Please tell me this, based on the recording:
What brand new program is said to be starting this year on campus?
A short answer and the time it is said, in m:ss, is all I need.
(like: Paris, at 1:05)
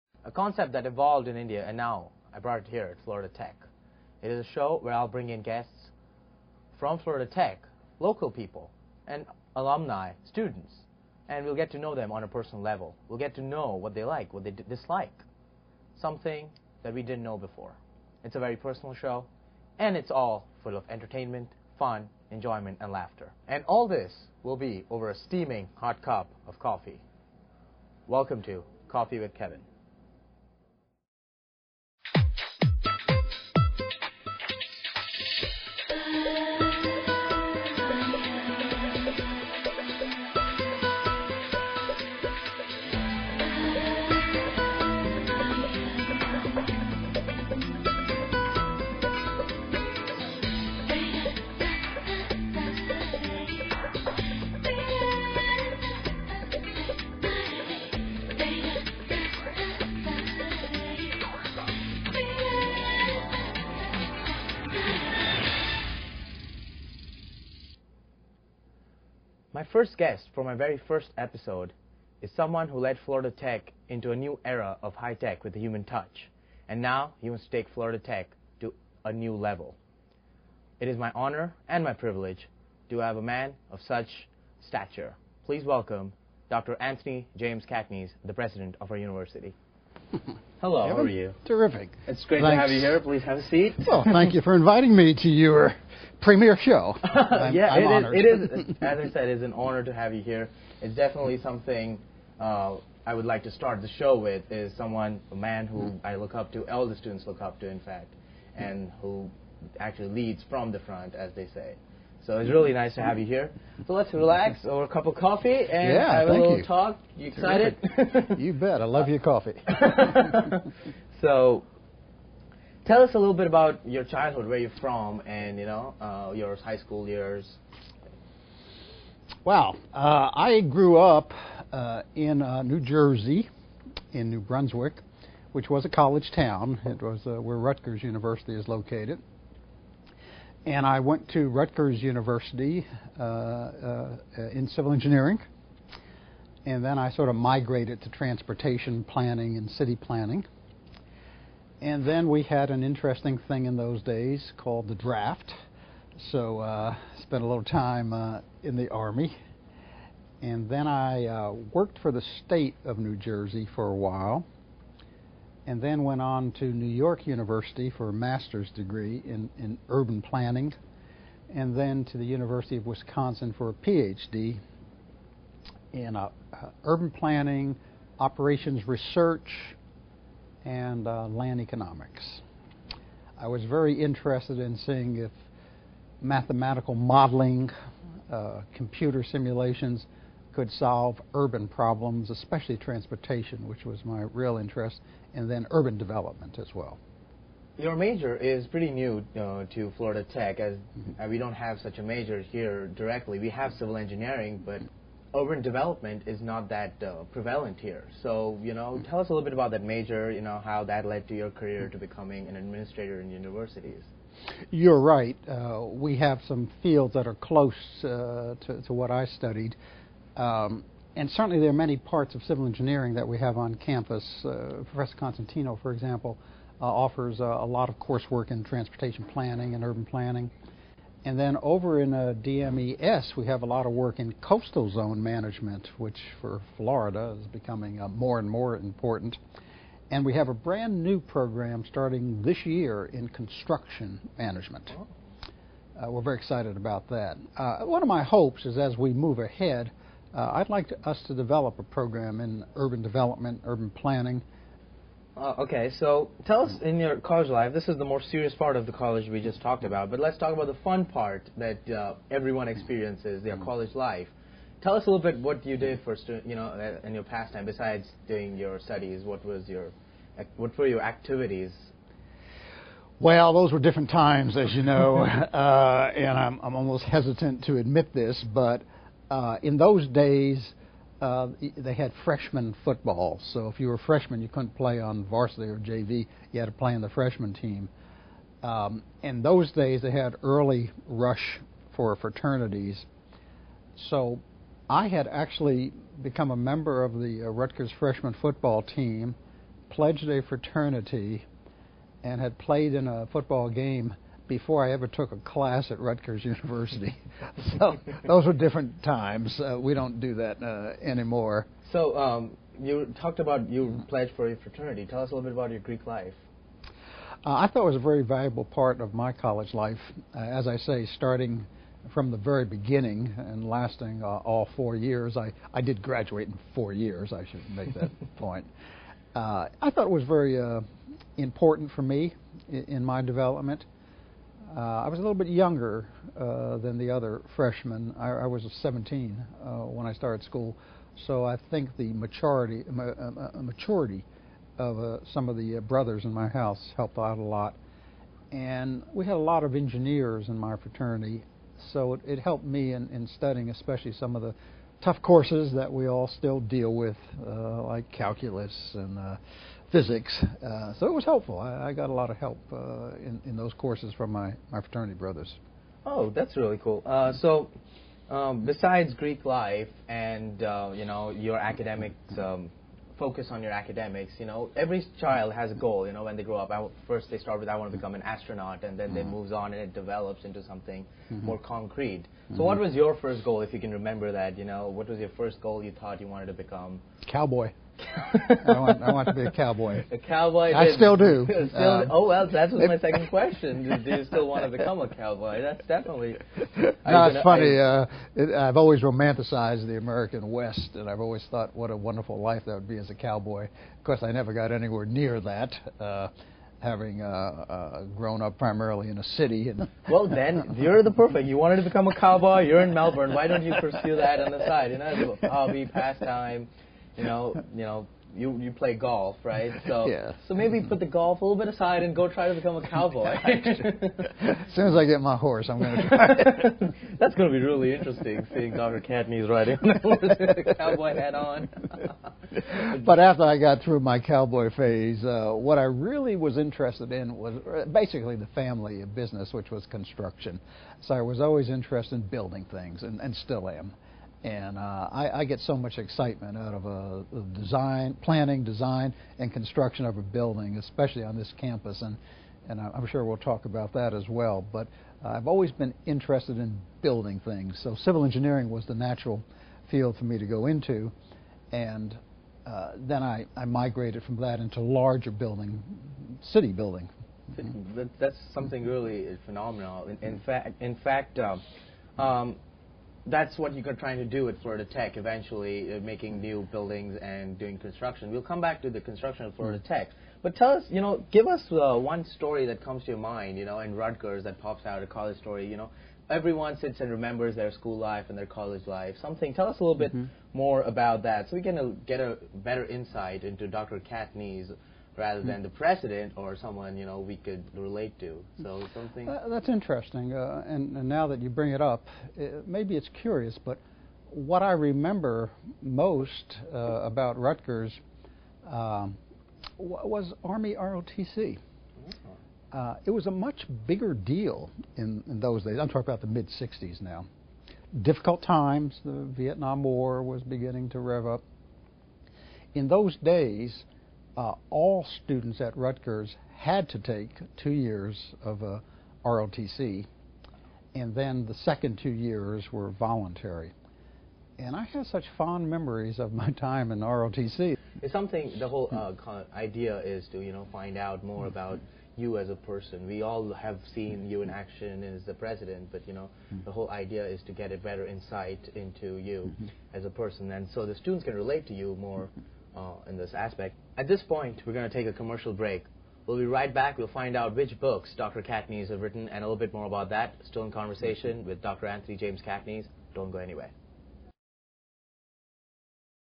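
construction management, at 4:03.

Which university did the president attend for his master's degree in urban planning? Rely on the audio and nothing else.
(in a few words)
New York University.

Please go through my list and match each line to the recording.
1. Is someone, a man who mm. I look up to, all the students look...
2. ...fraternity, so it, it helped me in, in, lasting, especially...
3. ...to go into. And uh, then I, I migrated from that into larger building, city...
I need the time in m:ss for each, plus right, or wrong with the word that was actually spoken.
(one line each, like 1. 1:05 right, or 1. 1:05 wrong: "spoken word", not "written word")
1. 1:44 right
2. 5:50 wrong: "studying", not "lasting"
3. 7:40 right.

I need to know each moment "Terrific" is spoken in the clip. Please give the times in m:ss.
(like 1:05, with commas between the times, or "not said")
1:31.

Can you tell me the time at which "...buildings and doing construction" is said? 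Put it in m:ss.
7:56.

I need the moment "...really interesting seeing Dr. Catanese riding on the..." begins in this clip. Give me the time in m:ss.
7:07.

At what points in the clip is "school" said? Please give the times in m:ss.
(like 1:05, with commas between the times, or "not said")
2:06, 5:40, 8:07.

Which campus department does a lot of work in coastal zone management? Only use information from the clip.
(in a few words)
DMES.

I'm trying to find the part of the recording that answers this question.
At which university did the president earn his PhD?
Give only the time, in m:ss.
2:52.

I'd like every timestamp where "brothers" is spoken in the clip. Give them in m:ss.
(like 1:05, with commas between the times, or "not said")
5:45, 6:05.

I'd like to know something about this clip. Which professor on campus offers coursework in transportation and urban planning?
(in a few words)
Professor Constantino.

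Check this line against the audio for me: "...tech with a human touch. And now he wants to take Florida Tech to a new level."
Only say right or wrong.
right.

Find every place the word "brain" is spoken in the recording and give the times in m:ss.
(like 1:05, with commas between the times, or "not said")
not said.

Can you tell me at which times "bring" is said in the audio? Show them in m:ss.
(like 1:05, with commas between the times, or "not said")
0:05, 8:21.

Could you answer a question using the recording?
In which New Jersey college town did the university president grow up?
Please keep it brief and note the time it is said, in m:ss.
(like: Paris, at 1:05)
New Brunswick, at 2:14.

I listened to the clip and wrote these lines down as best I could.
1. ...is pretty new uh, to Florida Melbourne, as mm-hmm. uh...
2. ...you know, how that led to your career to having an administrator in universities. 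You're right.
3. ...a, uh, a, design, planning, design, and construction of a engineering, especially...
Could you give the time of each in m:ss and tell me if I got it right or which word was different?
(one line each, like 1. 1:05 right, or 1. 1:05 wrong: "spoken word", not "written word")
1. 3:18 wrong: "Tech", not "Melbourne"
2. 3:30 wrong: "becoming", not "having"
3. 7:26 wrong: "building", not "engineering".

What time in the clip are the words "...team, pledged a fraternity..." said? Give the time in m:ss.
4:58.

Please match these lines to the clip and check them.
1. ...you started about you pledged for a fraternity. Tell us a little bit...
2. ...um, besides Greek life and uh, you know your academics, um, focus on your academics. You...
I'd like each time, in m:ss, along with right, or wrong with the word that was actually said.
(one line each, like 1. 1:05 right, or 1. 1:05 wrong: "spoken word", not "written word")
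1. 5:12 wrong: "talked", not "started"
2. 6:08 right.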